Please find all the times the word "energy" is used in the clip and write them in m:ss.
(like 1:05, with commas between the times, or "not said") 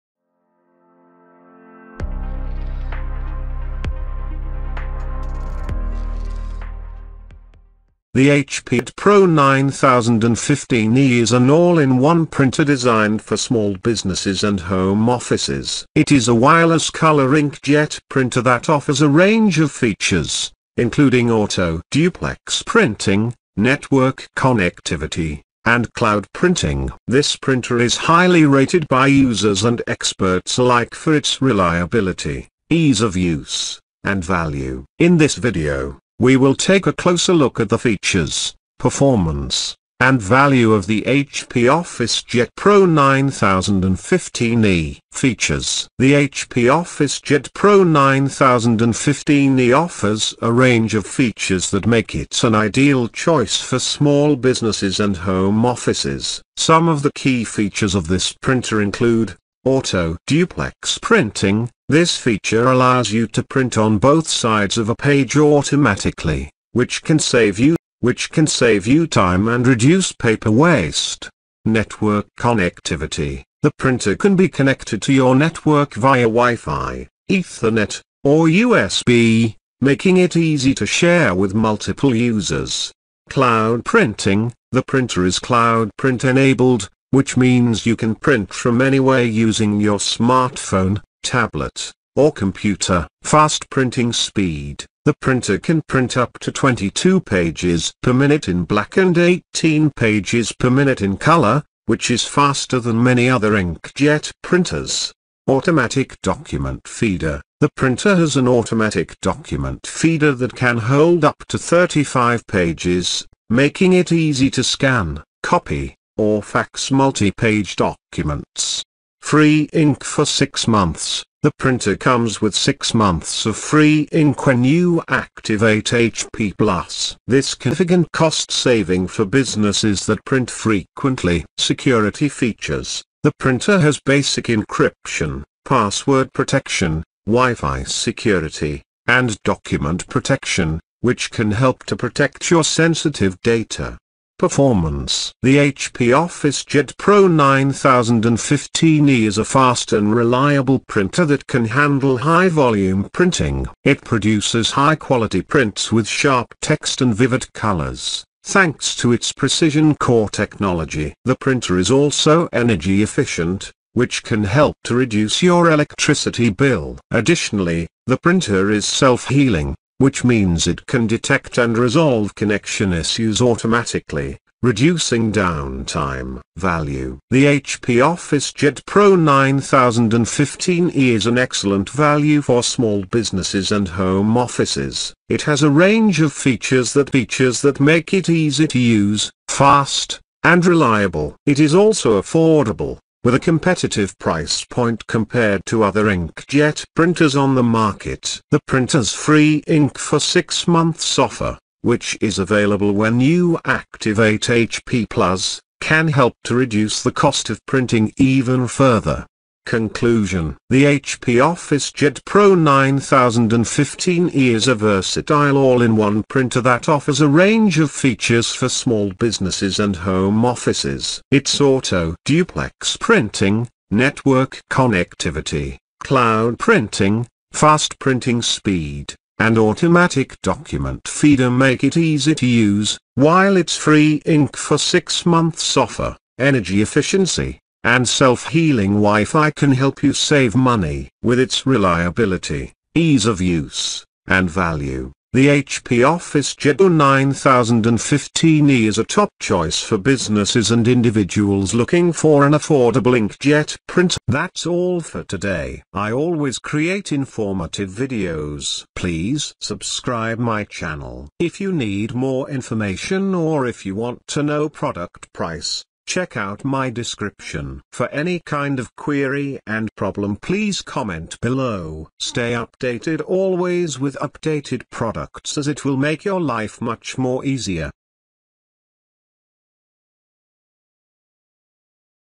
2:42, 3:56.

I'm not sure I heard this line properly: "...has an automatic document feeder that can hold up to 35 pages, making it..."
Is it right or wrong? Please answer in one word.
right.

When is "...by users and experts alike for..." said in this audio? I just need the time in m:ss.
0:28.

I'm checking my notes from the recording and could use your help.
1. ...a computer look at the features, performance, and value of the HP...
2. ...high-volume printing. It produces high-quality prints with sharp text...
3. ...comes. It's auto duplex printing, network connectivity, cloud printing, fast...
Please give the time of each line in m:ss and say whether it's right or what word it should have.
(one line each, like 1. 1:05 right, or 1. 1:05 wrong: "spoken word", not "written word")
1. 0:36 wrong: "closer", not "computer"
2. 2:32 right
3. 3:40 wrong: "offices", not "comes".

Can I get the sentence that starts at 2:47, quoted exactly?
Additionally, the printer is self-healing, which means it can detect and resolve connection issues automatically, reducing downtime.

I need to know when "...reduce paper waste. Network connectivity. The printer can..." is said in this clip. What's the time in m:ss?
1:09.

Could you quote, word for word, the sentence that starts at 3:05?
It has a range of features that features that make it easy to use, fast, and reliable.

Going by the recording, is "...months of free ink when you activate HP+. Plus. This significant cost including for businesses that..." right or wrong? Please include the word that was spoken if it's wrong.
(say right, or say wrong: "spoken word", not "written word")
wrong: "saving", not "including".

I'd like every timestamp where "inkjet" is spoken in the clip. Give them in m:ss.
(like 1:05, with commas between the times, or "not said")
0:17, 1:43, 3:16, 4:13.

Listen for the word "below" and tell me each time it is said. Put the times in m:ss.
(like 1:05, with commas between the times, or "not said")
4:31.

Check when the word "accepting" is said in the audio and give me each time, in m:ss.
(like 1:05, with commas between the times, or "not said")
not said.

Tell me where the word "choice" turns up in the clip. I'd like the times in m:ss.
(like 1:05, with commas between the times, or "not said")
0:53, 4:09.